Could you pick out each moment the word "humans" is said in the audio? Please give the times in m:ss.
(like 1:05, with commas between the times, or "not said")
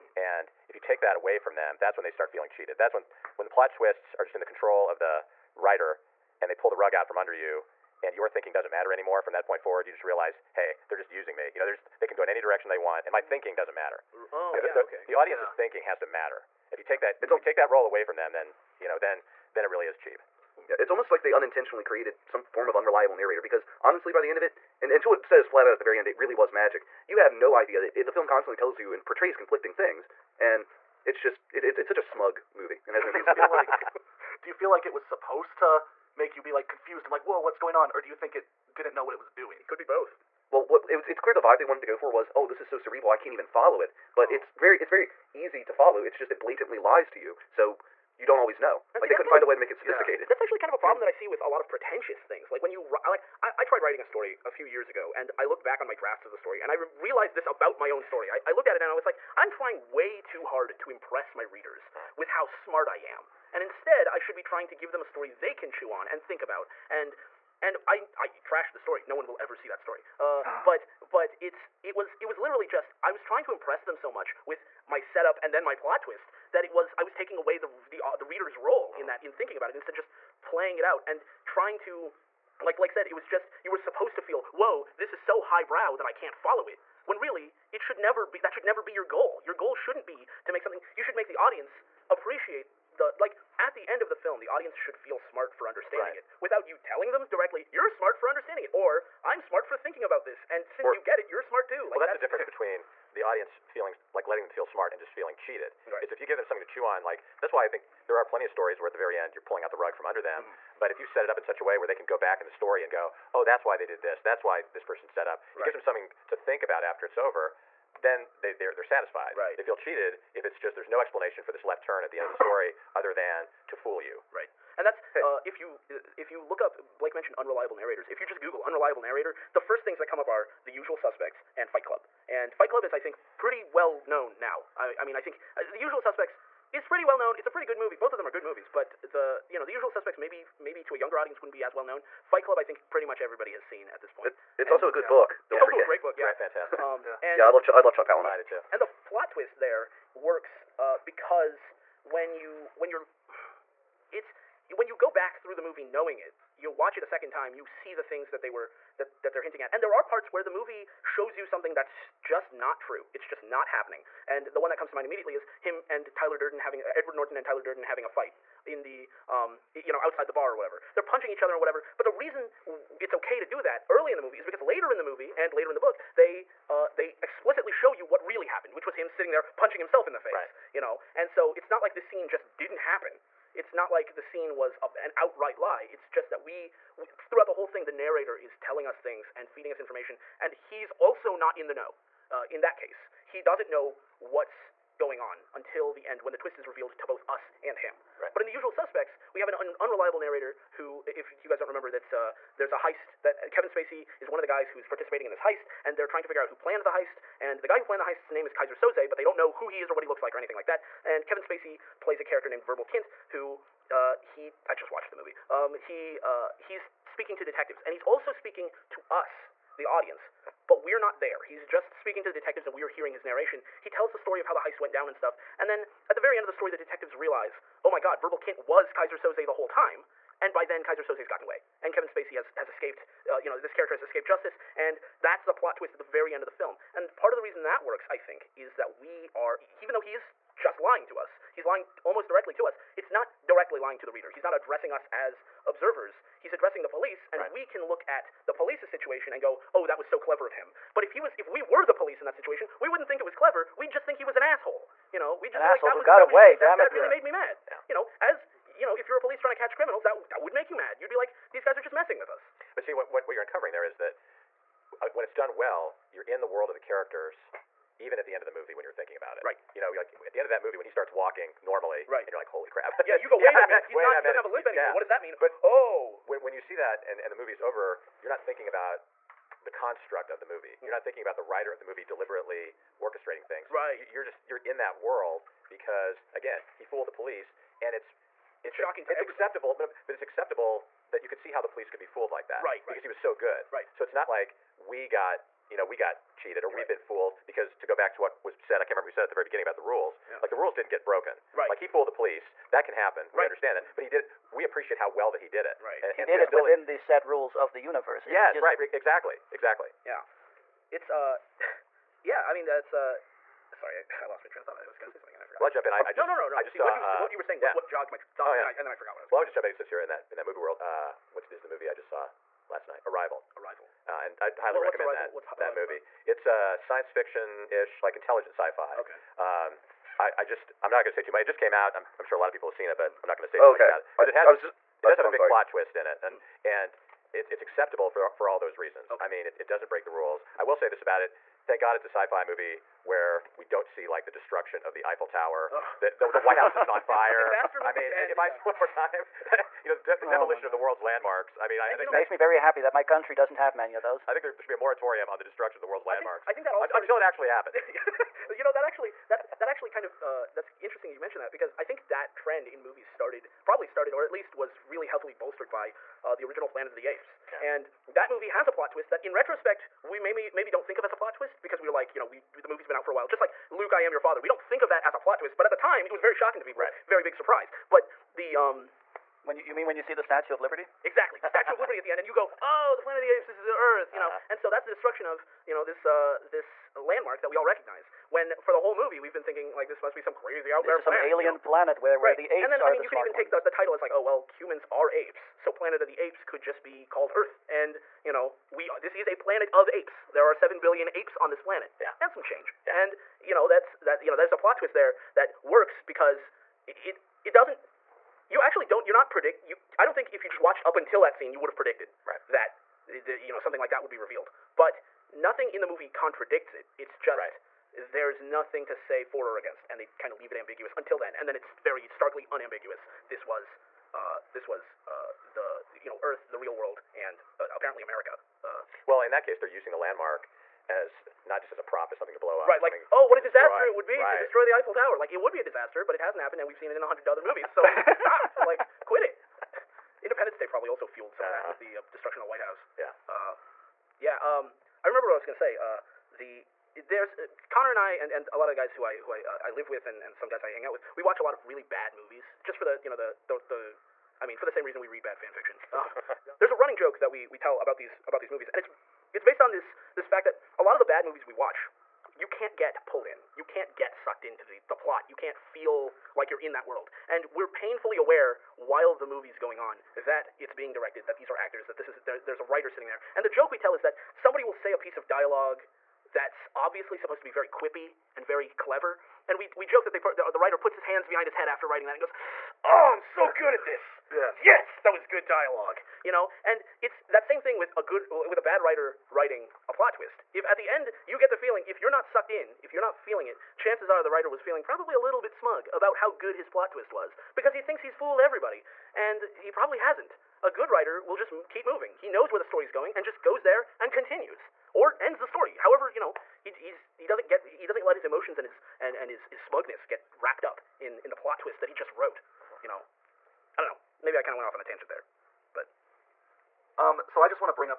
6:34.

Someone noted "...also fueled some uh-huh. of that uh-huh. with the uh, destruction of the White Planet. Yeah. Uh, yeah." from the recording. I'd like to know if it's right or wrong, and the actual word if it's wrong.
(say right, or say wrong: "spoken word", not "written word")
wrong: "House", not "Planet".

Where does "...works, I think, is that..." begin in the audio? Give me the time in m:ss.
3:57.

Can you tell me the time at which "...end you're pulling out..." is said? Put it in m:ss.
1:49.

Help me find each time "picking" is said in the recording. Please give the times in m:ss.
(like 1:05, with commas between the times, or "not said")
not said.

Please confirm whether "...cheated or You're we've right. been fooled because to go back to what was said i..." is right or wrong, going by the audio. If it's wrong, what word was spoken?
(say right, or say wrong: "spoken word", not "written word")
right.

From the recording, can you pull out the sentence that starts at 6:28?
When for the whole movie we've been thinking like this must be some crazy out there.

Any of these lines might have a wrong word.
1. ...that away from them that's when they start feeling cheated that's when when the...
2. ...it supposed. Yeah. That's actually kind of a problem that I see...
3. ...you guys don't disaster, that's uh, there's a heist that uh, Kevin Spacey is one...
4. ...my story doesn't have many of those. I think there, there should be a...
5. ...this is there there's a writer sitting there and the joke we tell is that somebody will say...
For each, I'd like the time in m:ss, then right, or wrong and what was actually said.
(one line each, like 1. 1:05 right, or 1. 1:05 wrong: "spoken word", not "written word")
1. 0:01 right
2. 0:49 wrong: "sophisticated", not "supposed"
3. 3:21 wrong: "remember", not "disaster"
4. 5:52 wrong: "country", not "story"
5. 7:51 right.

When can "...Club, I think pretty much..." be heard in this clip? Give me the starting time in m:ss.
2:22.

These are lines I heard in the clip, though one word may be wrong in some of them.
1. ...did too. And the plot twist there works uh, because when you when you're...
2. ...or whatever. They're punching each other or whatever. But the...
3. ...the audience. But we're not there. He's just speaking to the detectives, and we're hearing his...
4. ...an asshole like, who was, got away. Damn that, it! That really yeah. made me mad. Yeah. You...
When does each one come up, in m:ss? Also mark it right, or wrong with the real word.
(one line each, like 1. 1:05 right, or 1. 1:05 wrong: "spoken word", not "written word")
1. 2:28 right
2. 2:50 right
3. 3:39 right
4. 4:15 right.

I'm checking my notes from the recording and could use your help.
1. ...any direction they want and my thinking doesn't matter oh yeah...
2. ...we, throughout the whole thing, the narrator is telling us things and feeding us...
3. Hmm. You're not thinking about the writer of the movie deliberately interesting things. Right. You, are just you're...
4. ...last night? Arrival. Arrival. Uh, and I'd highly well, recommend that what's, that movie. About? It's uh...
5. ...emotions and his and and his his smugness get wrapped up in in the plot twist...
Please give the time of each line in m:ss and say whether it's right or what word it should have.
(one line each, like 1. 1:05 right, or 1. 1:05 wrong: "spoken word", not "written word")
1. 0:12 right
2. 3:06 right
3. 4:40 wrong: "orchestrating", not "interesting"
4. 5:22 right
5. 8:28 right.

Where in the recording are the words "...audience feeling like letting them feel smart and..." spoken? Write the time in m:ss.
1:43.